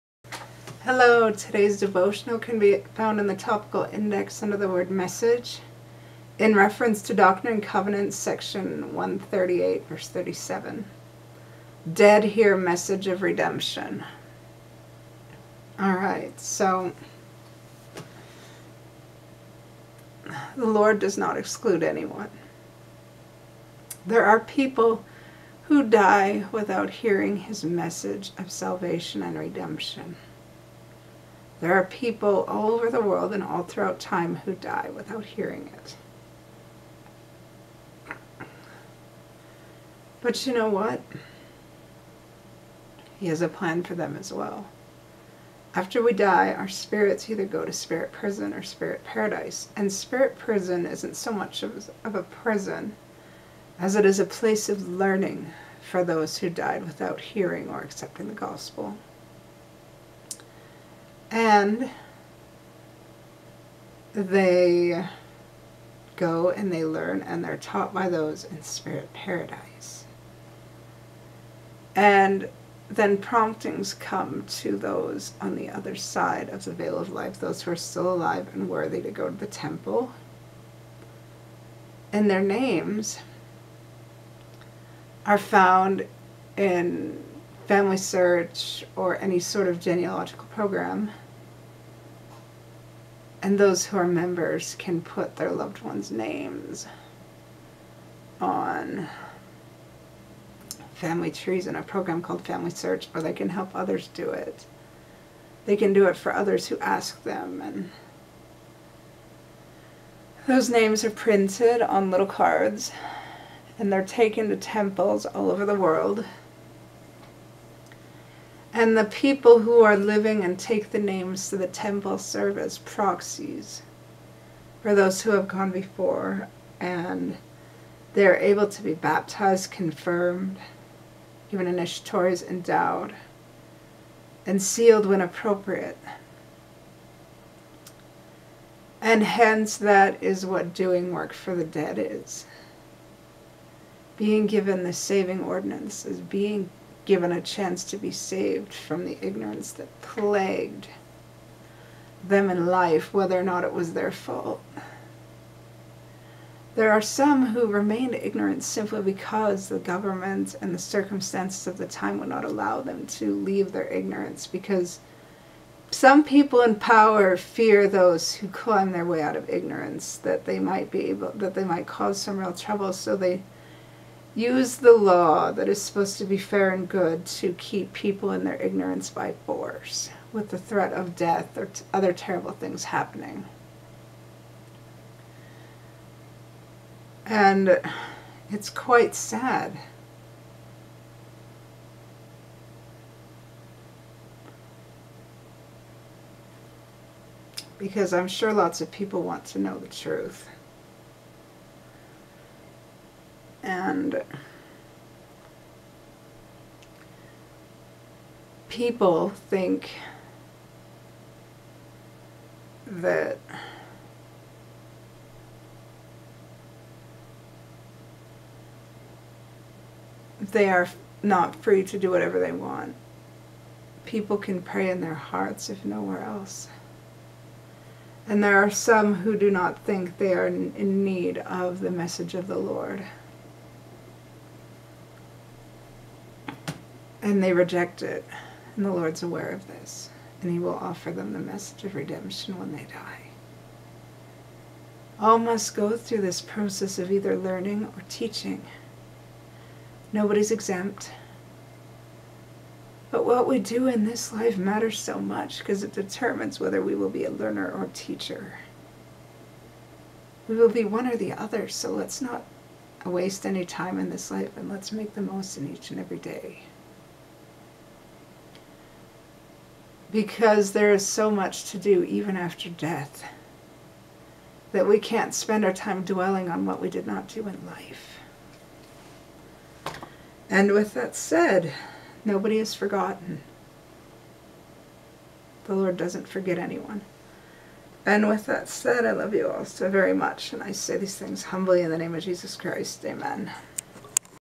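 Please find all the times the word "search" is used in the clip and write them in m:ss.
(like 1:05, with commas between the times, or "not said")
1:27, 1:42.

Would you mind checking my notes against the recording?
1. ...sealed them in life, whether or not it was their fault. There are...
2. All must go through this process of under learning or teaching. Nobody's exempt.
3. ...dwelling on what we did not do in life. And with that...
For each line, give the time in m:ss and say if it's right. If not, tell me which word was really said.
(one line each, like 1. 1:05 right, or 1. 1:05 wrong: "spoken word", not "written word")
1. 2:30 wrong: "plagued", not "sealed"
2. 4:05 wrong: "either", not "under"
3. 4:36 right.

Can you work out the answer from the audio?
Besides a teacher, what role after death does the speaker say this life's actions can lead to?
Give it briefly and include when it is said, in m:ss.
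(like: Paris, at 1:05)
Learner, at 4:17.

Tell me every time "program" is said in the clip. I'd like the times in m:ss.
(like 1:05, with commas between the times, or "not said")
1:30, 1:41.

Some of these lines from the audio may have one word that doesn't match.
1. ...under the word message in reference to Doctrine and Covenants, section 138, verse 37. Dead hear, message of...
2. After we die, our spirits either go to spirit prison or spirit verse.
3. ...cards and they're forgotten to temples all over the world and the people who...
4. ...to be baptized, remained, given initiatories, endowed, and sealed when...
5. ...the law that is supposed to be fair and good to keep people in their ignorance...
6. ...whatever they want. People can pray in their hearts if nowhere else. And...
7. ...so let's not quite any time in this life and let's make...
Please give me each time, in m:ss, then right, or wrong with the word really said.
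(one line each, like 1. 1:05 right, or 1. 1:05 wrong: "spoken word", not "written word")
1. 0:04 right
2. 0:45 wrong: "paradise", not "verse"
3. 1:52 wrong: "taken", not "forgotten"
4. 2:08 wrong: "confirmed", not "remained"
5. 2:54 right
6. 3:42 right
7. 4:21 wrong: "waste", not "quite".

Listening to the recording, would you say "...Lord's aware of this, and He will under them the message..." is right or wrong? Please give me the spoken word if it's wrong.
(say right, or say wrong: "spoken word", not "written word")
wrong: "offer", not "under".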